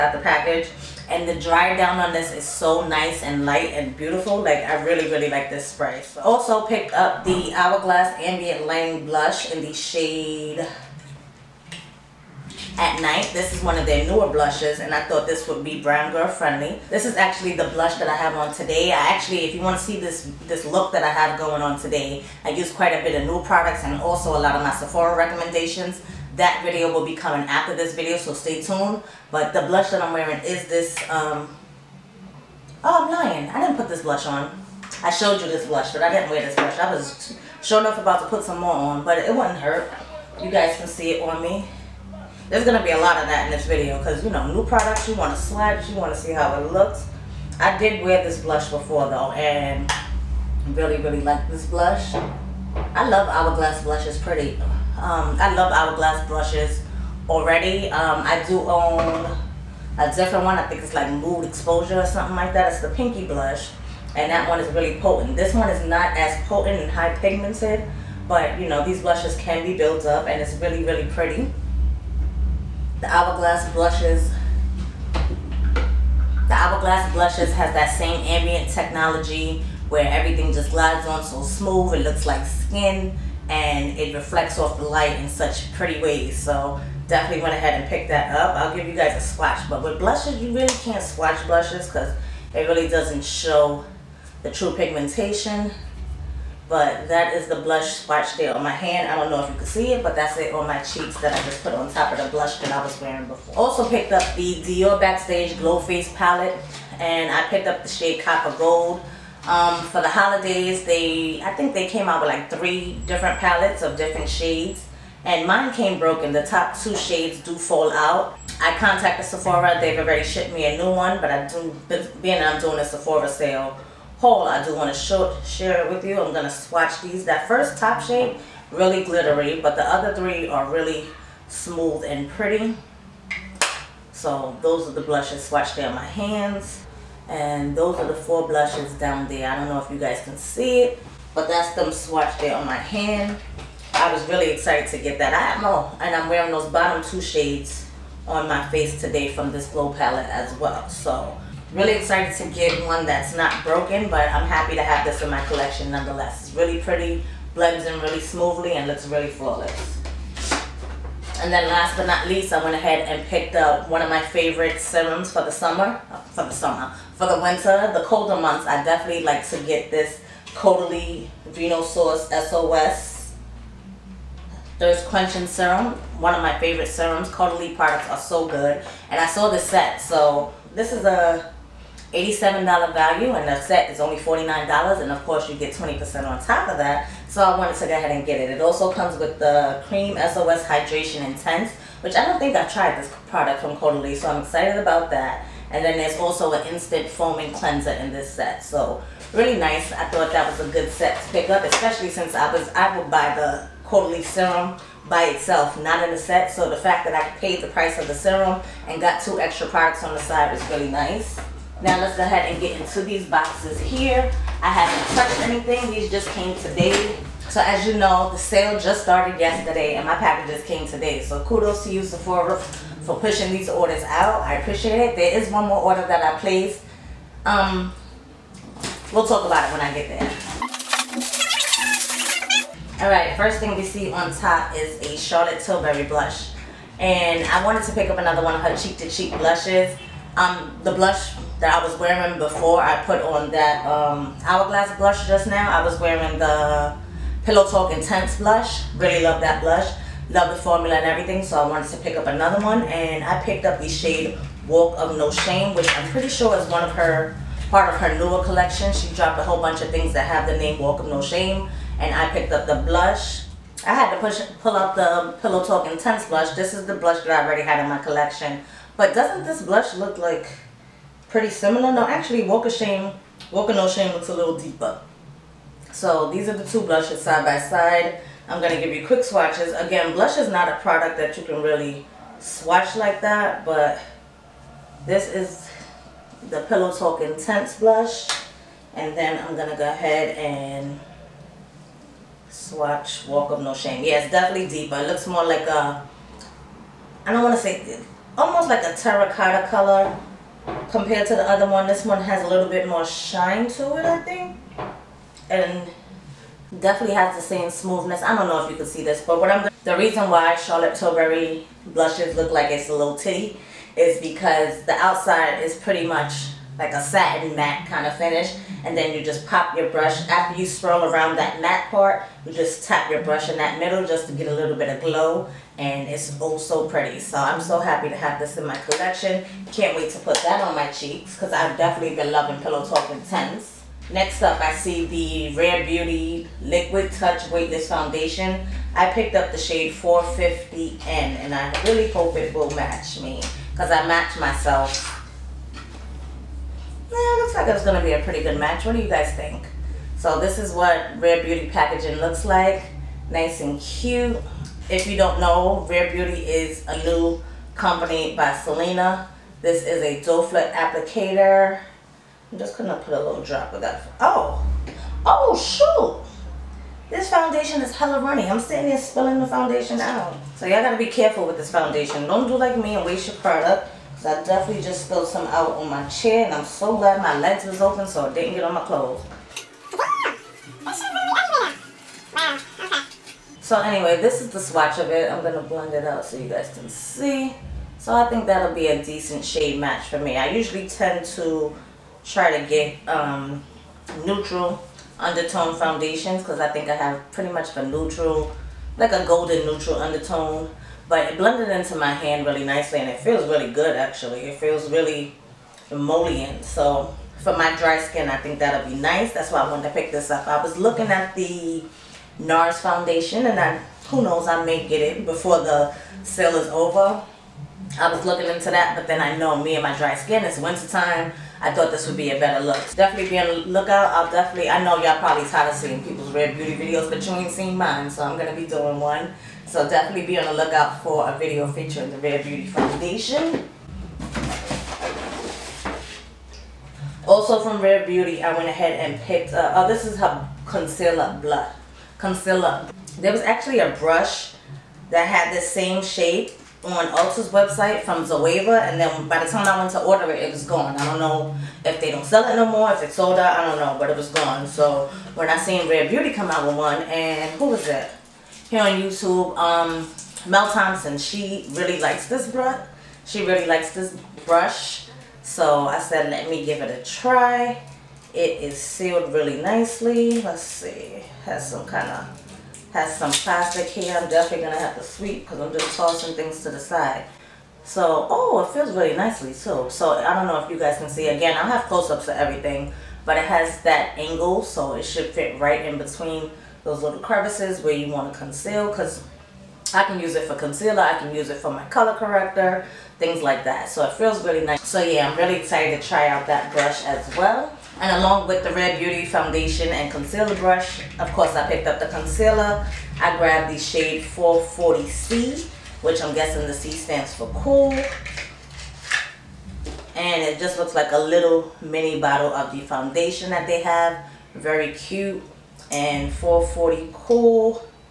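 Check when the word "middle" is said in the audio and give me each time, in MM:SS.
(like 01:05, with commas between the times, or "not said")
05:23.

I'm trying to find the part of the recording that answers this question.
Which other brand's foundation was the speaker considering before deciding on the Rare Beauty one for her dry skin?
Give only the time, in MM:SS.
06:52.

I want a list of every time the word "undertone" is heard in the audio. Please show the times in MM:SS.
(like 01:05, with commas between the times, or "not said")
06:35, 06:39.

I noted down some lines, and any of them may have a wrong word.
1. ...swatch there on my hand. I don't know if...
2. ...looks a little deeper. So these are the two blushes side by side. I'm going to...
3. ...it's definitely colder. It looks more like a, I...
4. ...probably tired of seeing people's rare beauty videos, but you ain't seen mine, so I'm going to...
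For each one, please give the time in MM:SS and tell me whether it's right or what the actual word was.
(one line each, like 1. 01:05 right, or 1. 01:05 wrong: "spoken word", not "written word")
1. 01:38 right
2. 04:34 right
3. 04:54 wrong: "deeper", not "colder"
4. 07:05 right.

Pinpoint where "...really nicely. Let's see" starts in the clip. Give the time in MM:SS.
07:49.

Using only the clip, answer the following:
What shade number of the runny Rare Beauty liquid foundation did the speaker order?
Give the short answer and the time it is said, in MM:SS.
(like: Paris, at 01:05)
450N, at 05:39.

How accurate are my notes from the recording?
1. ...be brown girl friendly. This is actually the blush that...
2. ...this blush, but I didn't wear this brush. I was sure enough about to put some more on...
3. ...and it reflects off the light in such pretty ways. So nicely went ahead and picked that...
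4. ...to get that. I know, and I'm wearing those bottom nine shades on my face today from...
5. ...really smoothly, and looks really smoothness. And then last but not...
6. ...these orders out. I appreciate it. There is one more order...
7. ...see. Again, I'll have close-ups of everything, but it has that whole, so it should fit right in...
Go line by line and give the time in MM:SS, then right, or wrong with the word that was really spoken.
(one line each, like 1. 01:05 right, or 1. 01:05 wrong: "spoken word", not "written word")
1. 00:15 right
2. 00:35 wrong: "blush", not "brush"
3. 01:23 wrong: "definitely", not "nicely"
4. 02:24 wrong: "two", not "nine"
5. 02:38 wrong: "flawless", not "smoothness"
6. 03:43 right
7. 08:01 wrong: "angle", not "whole".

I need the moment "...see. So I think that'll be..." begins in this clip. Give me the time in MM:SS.
06:26.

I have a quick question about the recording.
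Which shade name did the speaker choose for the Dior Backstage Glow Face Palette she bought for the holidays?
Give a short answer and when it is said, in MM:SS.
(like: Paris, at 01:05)
Copper Gold, at 01:48.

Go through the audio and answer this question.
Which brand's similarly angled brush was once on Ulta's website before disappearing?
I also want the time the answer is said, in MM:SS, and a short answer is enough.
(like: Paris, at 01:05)
Zoeva, at 07:28.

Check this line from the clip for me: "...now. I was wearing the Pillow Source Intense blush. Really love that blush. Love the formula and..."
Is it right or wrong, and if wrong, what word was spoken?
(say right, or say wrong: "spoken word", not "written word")
wrong: "Talk", not "Source".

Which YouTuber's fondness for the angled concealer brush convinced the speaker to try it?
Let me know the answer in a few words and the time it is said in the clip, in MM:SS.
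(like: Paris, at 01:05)
Mel Thompson, at 07:40.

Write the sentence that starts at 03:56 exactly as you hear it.
And I wanted to pick up another one of her cheek to cheek blushes.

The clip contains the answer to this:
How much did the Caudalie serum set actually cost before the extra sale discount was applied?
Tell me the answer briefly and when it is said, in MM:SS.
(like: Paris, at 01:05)
$49, at 03:04.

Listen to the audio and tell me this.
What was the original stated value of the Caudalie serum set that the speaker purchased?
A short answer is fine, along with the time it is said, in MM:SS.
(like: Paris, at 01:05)
$87, at 03:02.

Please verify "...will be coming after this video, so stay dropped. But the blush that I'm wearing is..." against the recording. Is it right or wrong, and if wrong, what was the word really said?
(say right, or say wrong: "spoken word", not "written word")
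wrong: "tuned", not "dropped".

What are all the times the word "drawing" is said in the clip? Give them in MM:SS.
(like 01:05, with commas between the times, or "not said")
not said.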